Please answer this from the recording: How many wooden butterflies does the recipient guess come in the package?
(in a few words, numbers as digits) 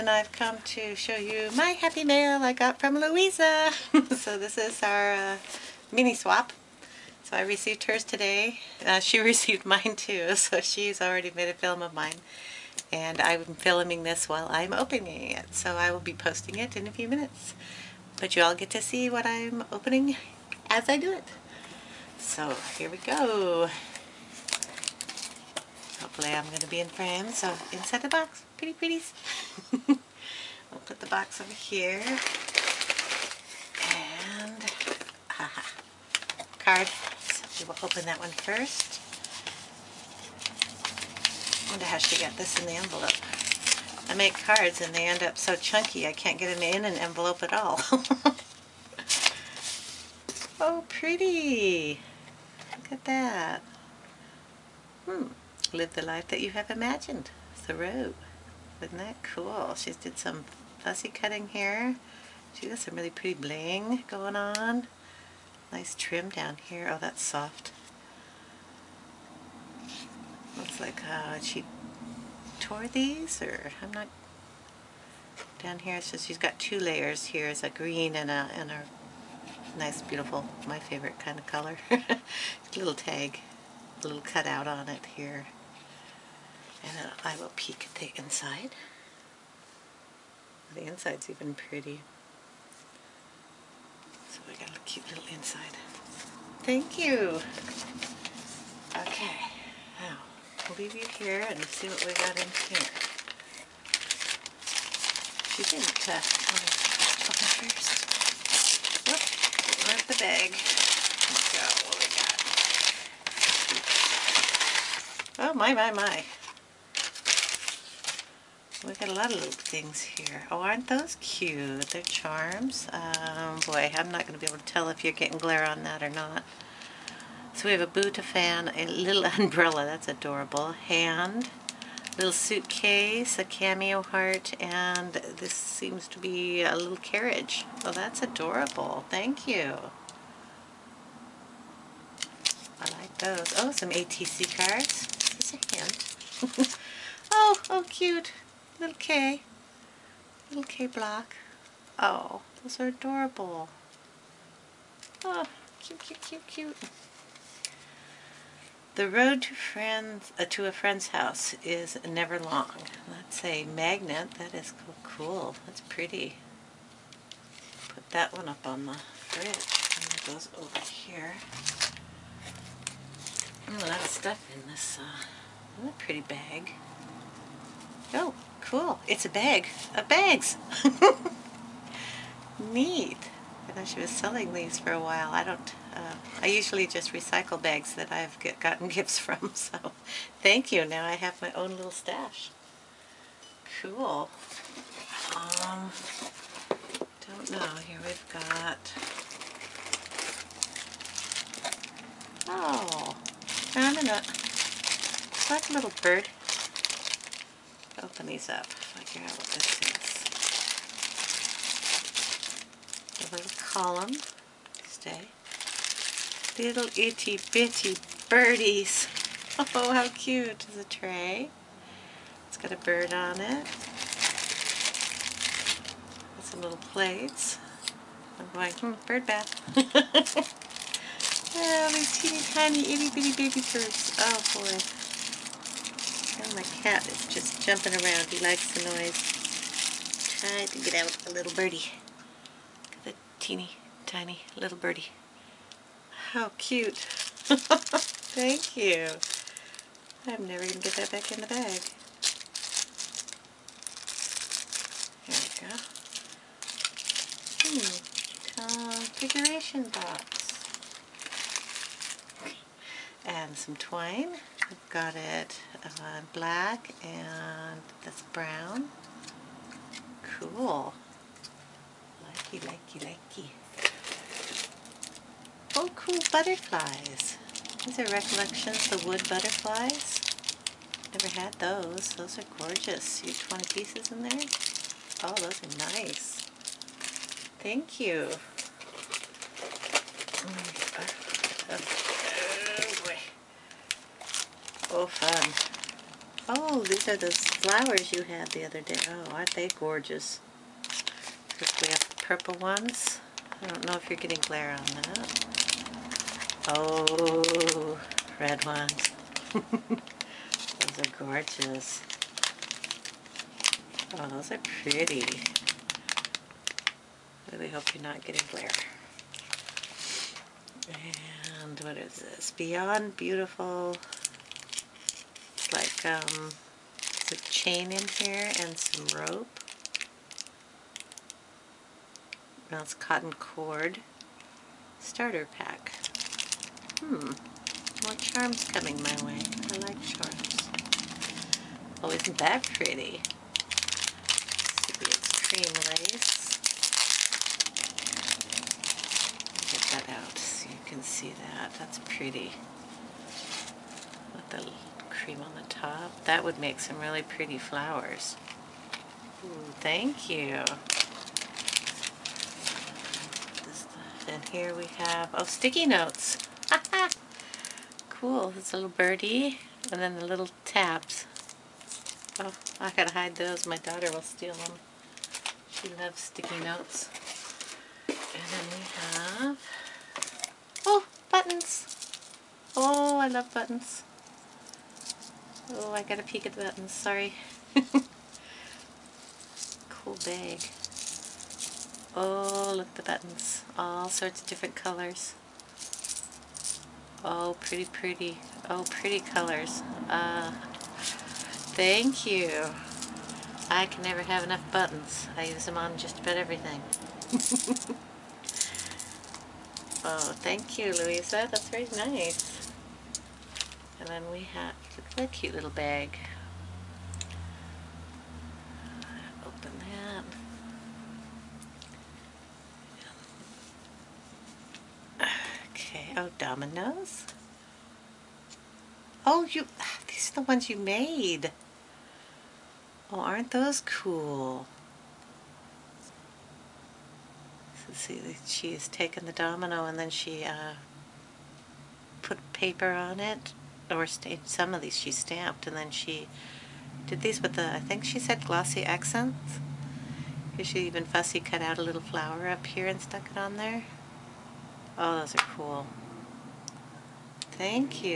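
20.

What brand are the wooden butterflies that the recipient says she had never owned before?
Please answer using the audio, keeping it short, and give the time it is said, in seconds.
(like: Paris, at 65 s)
Recollections, at 278 s.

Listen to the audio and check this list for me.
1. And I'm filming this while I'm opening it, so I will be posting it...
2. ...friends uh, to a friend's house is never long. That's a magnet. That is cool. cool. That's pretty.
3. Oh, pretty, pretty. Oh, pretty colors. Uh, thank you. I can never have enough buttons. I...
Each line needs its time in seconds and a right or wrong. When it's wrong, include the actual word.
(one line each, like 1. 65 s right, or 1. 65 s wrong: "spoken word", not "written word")
1. 12 s right
2. 159 s right
3. 397 s right.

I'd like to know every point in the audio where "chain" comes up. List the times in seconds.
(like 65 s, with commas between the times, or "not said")
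327 s.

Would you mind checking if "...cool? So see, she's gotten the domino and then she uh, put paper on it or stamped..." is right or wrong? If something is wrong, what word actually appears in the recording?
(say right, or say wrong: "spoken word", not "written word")
wrong: "taken", not "gotten".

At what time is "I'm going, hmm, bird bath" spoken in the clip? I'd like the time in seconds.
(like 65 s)
228 s.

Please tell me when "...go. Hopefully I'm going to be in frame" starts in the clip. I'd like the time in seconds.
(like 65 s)
22 s.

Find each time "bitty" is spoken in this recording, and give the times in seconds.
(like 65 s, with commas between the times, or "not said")
217 s, 233 s.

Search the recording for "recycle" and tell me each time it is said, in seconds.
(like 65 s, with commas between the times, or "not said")
187 s.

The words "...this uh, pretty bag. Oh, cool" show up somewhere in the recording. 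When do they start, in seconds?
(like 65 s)
174 s.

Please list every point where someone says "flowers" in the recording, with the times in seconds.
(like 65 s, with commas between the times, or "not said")
297 s, 357 s, 451 s.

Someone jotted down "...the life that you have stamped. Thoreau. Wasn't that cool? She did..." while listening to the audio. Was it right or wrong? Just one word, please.
wrong.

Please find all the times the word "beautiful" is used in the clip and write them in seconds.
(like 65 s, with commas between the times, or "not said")
80 s, 323 s.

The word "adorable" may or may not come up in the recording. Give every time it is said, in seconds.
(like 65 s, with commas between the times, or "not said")
130 s, 138 s, 152 s.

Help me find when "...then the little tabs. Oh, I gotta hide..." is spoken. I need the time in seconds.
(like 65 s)
369 s.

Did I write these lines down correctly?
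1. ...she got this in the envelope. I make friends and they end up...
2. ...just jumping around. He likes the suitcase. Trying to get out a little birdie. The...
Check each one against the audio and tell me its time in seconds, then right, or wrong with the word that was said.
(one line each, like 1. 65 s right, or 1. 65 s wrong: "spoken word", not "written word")
1. 41 s wrong: "cards", not "friends"
2. 237 s wrong: "noise", not "suitcase".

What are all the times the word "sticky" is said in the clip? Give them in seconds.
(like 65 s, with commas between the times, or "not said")
365 s, 376 s.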